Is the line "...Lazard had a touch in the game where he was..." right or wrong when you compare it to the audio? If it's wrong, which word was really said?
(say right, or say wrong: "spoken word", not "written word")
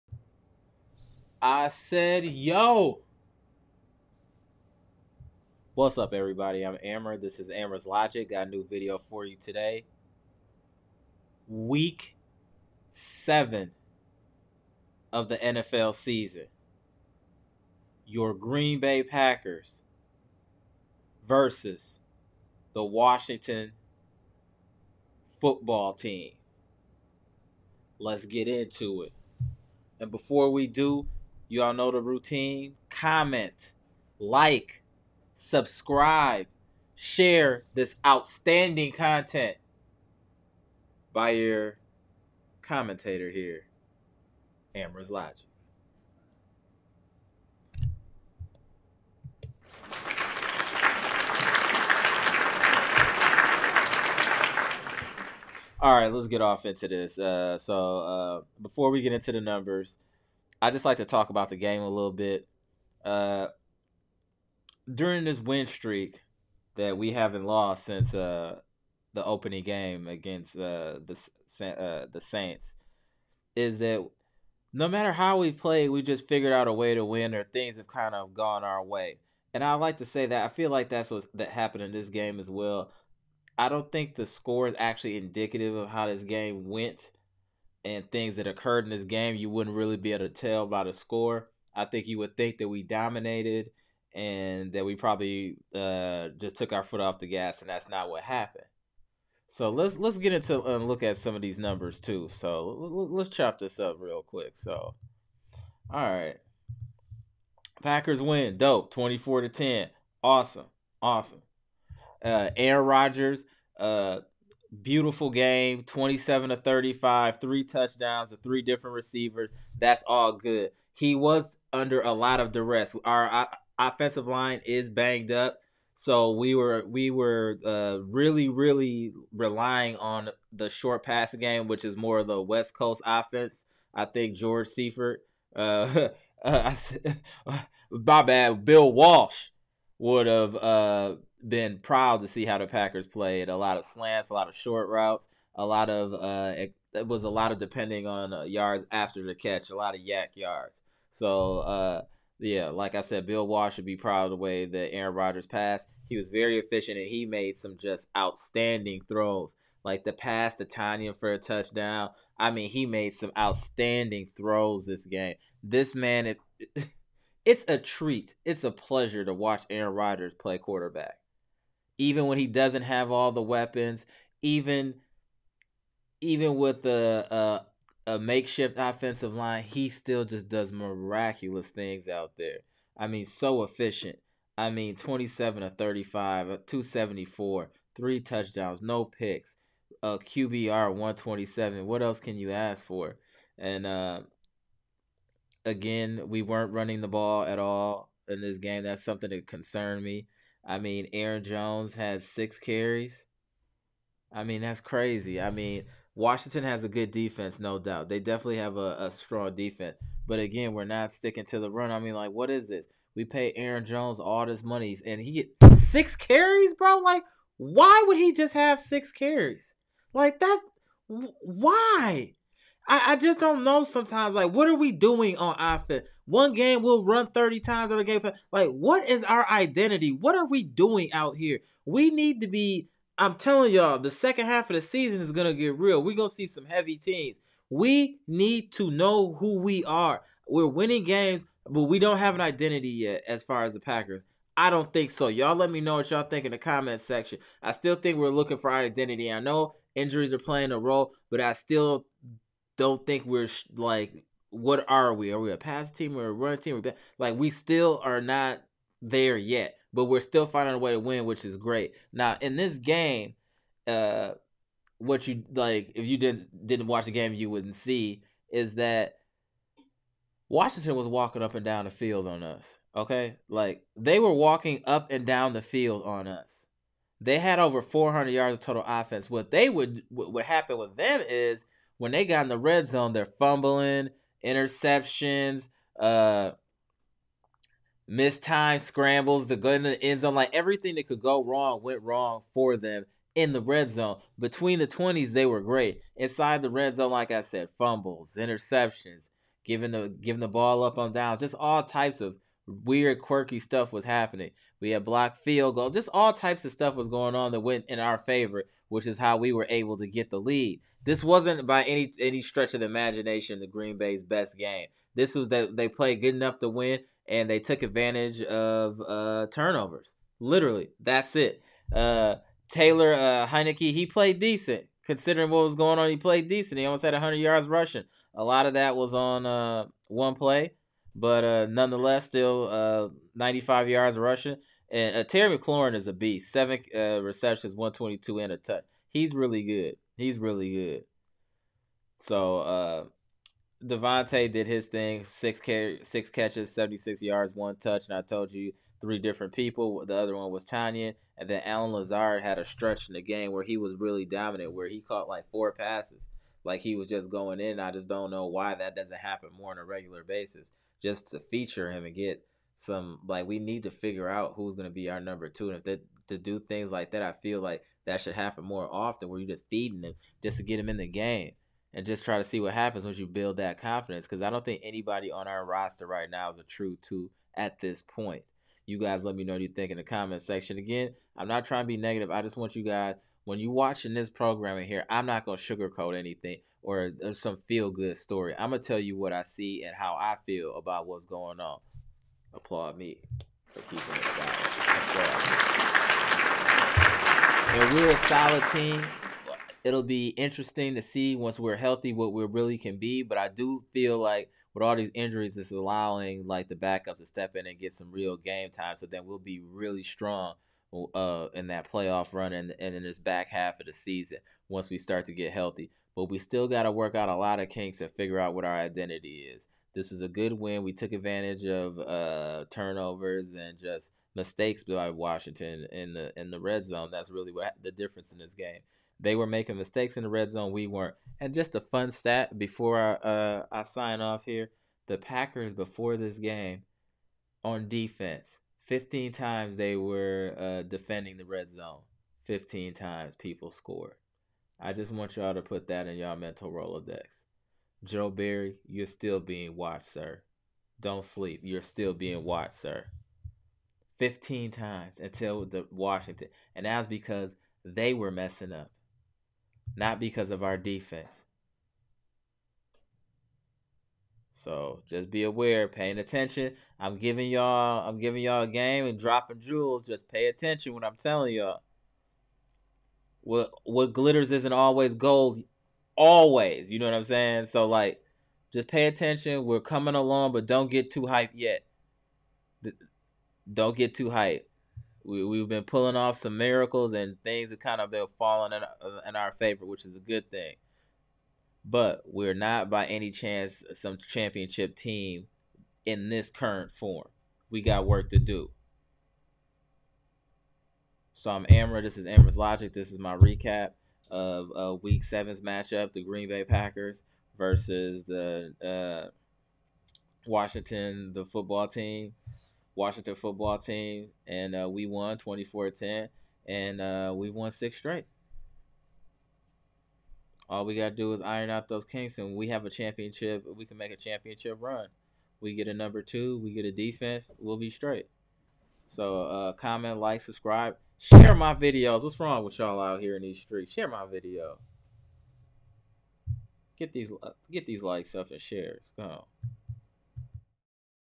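wrong: "stretch", not "touch".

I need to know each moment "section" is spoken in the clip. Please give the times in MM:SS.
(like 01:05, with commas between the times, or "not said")
04:07, 06:20.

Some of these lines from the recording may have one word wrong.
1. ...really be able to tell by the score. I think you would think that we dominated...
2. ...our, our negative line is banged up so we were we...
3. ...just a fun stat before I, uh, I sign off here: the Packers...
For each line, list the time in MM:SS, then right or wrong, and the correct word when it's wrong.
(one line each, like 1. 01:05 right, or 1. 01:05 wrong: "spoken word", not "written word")
1. 01:29 right
2. 02:03 wrong: "offensive", not "negative"
3. 07:11 right.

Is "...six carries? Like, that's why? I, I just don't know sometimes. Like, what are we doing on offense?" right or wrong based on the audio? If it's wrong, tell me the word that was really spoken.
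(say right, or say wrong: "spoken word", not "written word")
right.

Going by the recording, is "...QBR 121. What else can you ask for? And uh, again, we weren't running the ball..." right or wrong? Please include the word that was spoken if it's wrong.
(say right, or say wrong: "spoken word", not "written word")
wrong: "127", not "121".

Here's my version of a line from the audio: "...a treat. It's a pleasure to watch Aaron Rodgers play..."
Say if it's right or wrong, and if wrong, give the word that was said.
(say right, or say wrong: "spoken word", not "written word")
right.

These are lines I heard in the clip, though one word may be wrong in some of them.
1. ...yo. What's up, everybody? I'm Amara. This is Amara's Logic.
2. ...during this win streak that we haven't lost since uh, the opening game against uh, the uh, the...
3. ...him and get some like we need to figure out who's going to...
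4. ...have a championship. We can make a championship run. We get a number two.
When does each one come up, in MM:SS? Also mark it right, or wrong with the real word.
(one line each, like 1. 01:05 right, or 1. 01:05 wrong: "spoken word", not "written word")
1. 00:02 right
2. 01:04 right
3. 06:01 right
4. 08:42 right.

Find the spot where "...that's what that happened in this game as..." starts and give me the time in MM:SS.
01:20.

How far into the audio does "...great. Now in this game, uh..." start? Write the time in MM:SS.
04:21.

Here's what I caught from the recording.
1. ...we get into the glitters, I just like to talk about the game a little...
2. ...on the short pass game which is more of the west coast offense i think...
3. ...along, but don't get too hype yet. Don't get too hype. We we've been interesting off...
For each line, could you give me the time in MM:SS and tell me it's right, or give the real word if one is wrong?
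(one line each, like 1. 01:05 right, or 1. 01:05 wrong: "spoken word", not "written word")
1. 00:58 wrong: "numbers", not "glitters"
2. 02:09 right
3. 08:00 wrong: "pulling", not "interesting".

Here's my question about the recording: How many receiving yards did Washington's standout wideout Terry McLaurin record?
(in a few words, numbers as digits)
122.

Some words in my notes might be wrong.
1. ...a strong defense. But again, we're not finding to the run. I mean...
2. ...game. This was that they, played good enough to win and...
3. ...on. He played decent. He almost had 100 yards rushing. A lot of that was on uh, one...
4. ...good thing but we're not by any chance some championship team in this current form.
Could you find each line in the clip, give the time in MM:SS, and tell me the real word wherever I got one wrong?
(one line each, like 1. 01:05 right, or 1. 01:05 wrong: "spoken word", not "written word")
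1. 03:29 wrong: "sticking", not "finding"
2. 05:14 right
3. 05:25 right
4. 08:10 right.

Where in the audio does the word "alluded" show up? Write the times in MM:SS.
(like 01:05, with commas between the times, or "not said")
not said.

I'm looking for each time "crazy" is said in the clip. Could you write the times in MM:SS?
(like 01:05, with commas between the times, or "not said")
03:24.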